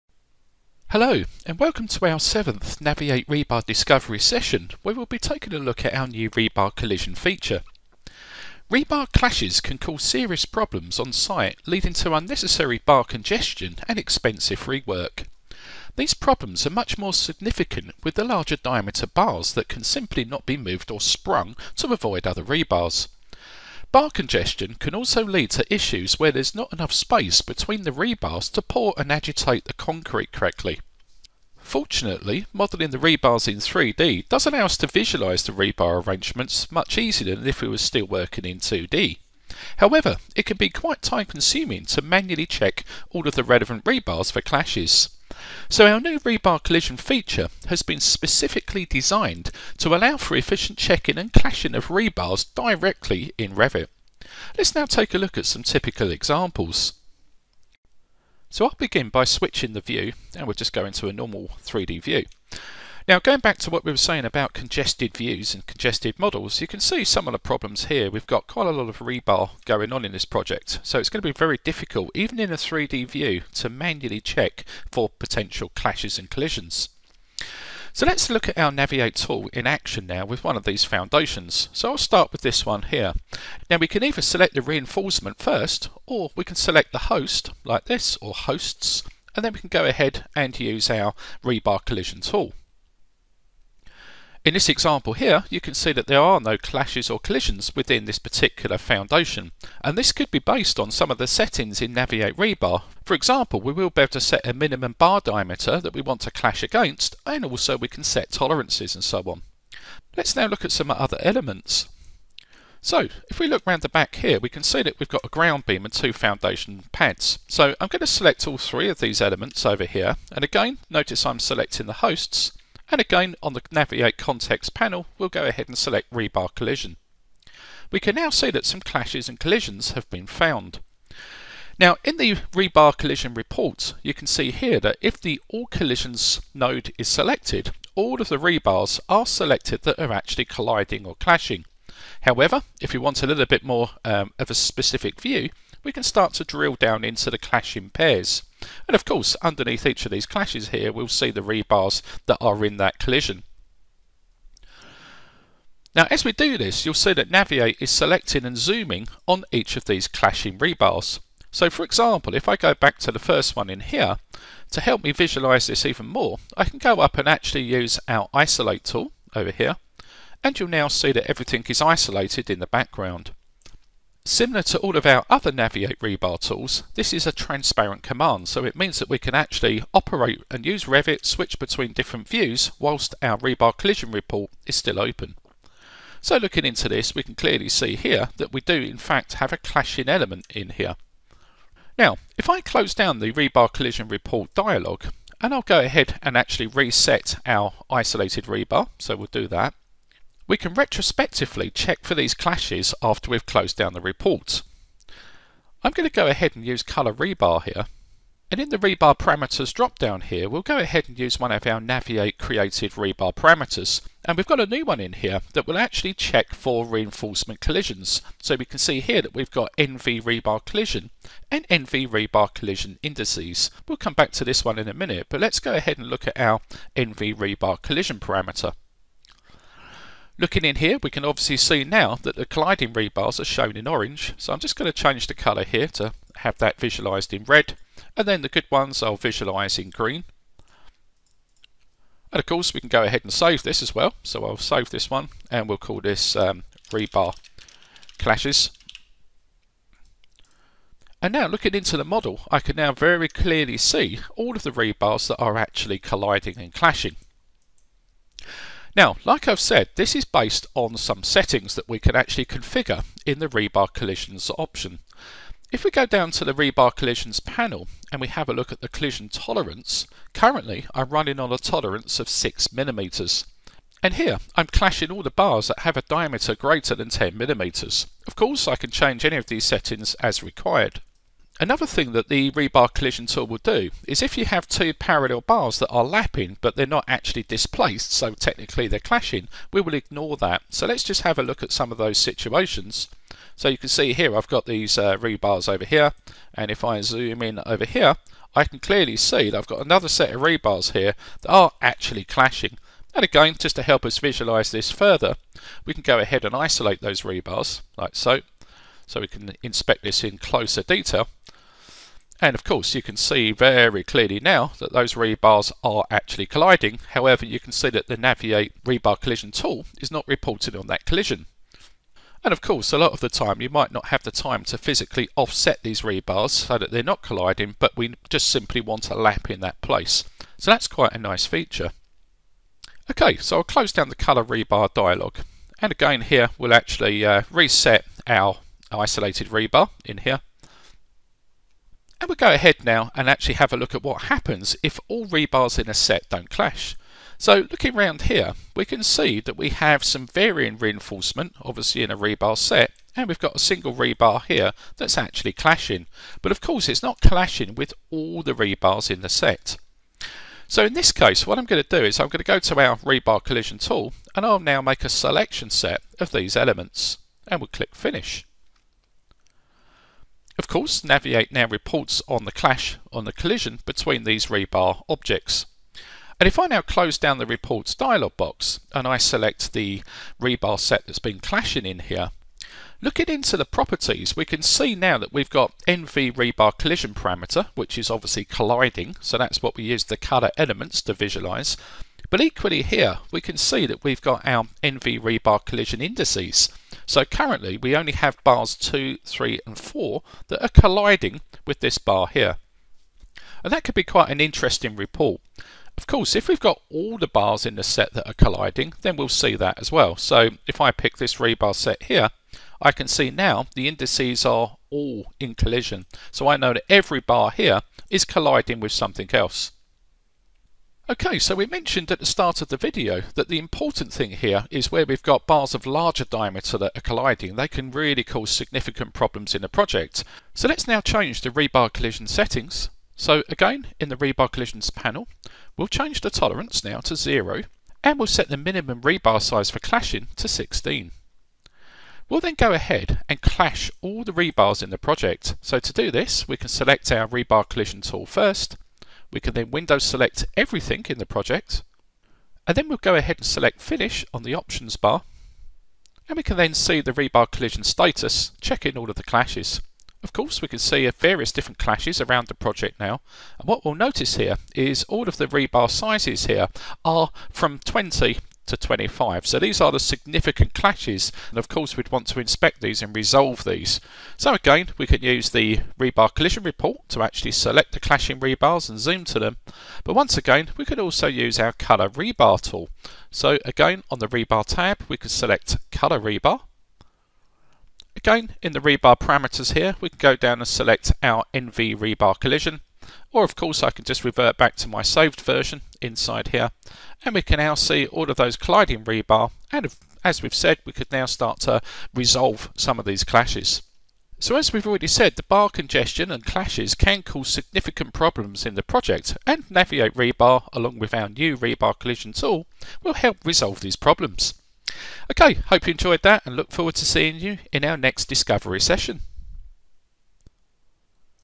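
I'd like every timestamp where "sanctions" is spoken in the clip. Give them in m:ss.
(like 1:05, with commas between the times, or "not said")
not said.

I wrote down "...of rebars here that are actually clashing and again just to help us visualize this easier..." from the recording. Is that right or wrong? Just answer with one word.
wrong.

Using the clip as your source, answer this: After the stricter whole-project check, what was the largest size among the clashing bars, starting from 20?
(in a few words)
25.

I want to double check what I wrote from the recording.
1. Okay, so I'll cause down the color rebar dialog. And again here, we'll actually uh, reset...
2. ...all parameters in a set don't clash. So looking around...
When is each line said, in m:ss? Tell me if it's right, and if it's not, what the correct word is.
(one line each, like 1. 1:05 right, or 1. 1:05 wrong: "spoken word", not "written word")
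1. 5:33 wrong: "close", not "cause"
2. 5:45 wrong: "rebars", not "parameters".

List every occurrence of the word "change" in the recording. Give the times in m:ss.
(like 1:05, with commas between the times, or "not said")
3:54, 4:38, 7:11, 7:15.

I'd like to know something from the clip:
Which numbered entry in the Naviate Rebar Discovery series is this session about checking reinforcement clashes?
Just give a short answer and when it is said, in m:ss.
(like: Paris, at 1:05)
Seventh, at 0:02.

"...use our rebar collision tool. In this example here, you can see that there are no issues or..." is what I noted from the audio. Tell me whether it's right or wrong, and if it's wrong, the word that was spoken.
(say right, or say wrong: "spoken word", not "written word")
wrong: "clashes", not "issues".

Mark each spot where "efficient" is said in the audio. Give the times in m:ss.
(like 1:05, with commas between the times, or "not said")
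0:50.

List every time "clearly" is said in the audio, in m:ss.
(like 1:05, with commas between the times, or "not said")
3:07, 4:13, 4:58, 5:14.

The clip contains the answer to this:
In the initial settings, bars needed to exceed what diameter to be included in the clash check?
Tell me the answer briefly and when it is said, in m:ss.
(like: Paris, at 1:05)
10 millimeters, at 4:37.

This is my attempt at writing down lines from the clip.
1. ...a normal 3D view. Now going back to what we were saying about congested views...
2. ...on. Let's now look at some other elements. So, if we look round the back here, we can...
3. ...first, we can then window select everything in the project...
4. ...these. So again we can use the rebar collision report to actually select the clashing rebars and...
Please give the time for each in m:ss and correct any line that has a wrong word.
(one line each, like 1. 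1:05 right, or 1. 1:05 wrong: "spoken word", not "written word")
1. 1:01 right
2. 1:49 right
3. 7:28 right
4. 7:53 right.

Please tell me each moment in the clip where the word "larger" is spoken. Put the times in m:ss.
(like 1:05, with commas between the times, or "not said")
0:18, 7:05.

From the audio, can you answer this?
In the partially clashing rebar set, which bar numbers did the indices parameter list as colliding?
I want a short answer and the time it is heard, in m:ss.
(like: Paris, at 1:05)
2, 3 and 4, at 6:38.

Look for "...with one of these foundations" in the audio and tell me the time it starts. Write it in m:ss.
1:20.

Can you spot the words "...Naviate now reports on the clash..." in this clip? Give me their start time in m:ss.
6:11.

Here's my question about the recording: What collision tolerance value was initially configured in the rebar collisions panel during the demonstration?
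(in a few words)
6 millimeters.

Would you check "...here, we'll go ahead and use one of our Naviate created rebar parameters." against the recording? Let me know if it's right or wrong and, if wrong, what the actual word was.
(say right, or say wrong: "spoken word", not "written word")
right.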